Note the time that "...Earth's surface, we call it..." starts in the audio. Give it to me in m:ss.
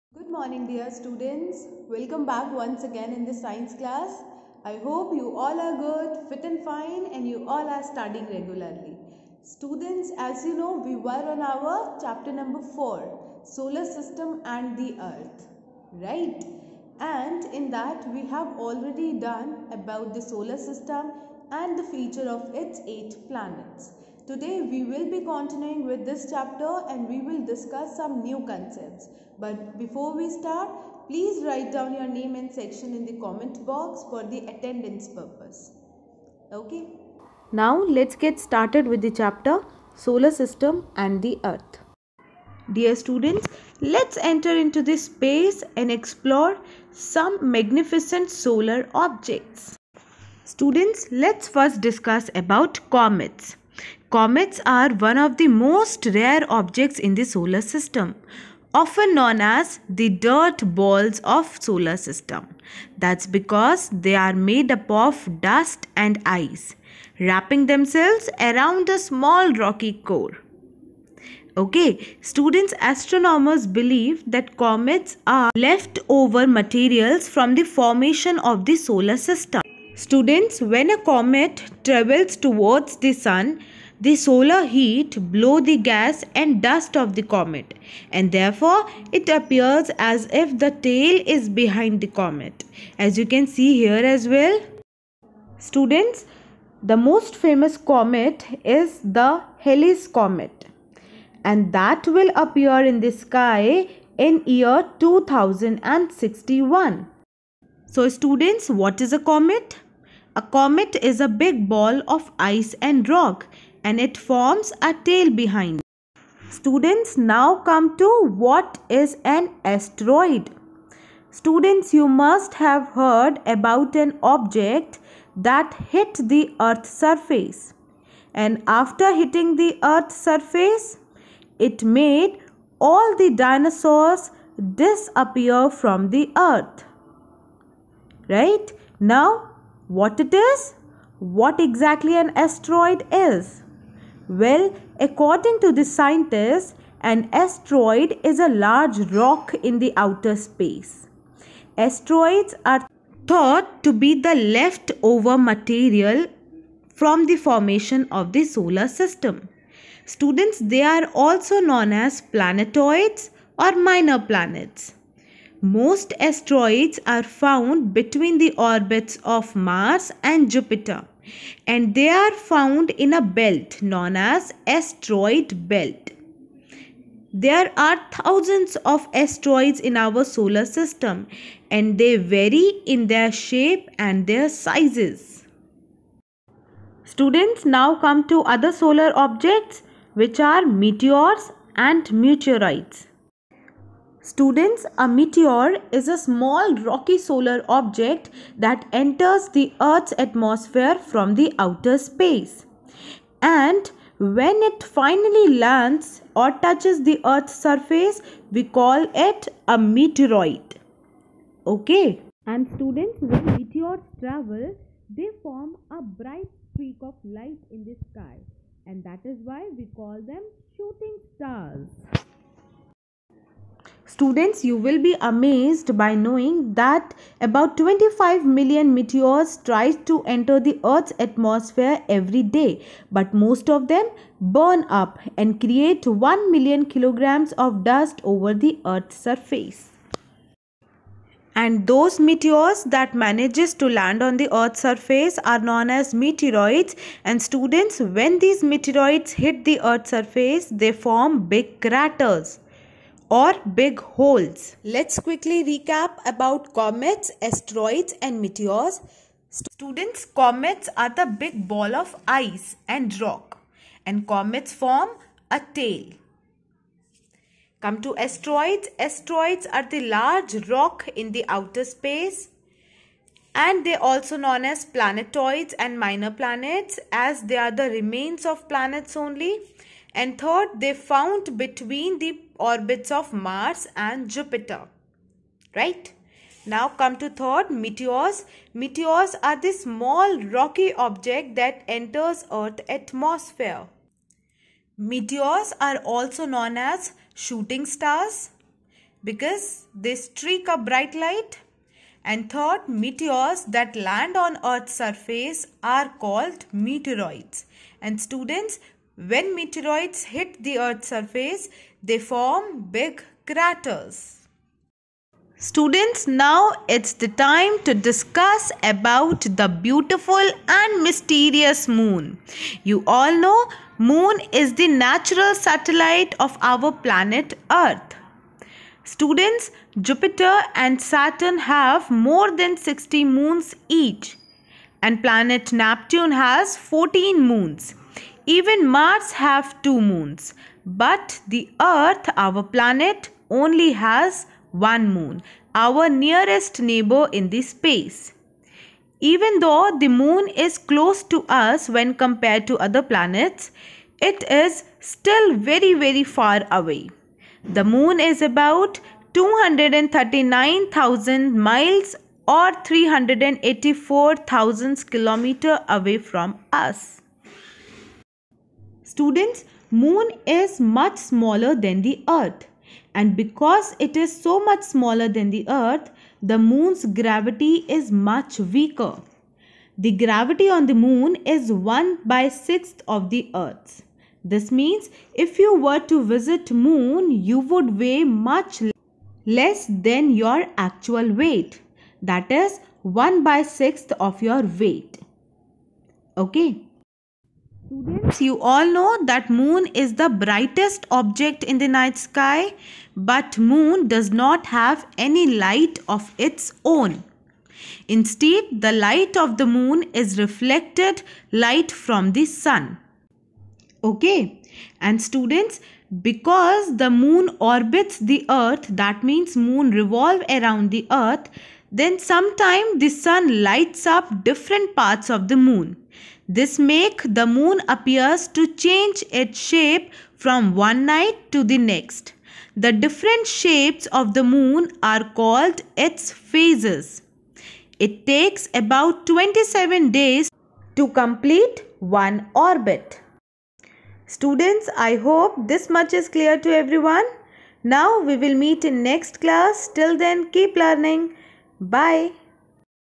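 3:27.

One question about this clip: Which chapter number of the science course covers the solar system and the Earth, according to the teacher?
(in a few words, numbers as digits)
4.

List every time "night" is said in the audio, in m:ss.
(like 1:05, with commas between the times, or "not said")
6:41, 7:11.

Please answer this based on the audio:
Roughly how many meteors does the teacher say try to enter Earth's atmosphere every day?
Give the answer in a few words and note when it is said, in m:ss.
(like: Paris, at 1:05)
25 million, at 3:47.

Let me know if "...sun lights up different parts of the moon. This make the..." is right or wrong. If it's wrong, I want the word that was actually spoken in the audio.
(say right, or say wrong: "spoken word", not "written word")
right.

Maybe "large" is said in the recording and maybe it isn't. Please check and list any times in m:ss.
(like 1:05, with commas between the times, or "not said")
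2:28, 4:30.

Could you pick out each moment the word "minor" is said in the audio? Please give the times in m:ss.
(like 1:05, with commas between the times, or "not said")
2:43, 4:35.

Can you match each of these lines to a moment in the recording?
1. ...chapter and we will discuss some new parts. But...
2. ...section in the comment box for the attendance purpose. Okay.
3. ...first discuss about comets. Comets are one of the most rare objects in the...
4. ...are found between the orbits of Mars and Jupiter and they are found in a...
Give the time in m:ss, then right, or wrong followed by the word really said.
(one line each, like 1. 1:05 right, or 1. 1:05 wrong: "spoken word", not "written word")
1. 0:26 wrong: "concepts", not "parts"
2. 0:32 right
3. 0:51 right
4. 2:47 right.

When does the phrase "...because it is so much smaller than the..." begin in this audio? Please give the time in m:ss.
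6:13.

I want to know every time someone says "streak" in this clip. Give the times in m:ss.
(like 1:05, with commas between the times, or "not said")
3:36, 5:00.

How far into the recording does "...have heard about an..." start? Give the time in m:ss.
2:02.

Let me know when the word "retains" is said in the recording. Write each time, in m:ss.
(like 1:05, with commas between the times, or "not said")
not said.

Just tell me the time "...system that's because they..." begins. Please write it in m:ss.
1:01.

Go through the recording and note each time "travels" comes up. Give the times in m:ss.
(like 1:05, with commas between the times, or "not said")
1:21, 3:34.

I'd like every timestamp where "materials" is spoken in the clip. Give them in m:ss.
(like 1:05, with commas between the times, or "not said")
1:16, 2:35.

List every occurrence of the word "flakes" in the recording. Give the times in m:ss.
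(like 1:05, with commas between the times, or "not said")
not said.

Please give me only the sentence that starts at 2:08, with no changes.
And after hitting the earth's surface, it made all the dinosaurs disappear from the earth right?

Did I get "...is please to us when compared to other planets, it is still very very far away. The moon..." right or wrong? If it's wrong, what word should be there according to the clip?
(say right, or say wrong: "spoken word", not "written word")
wrong: "close", not "please".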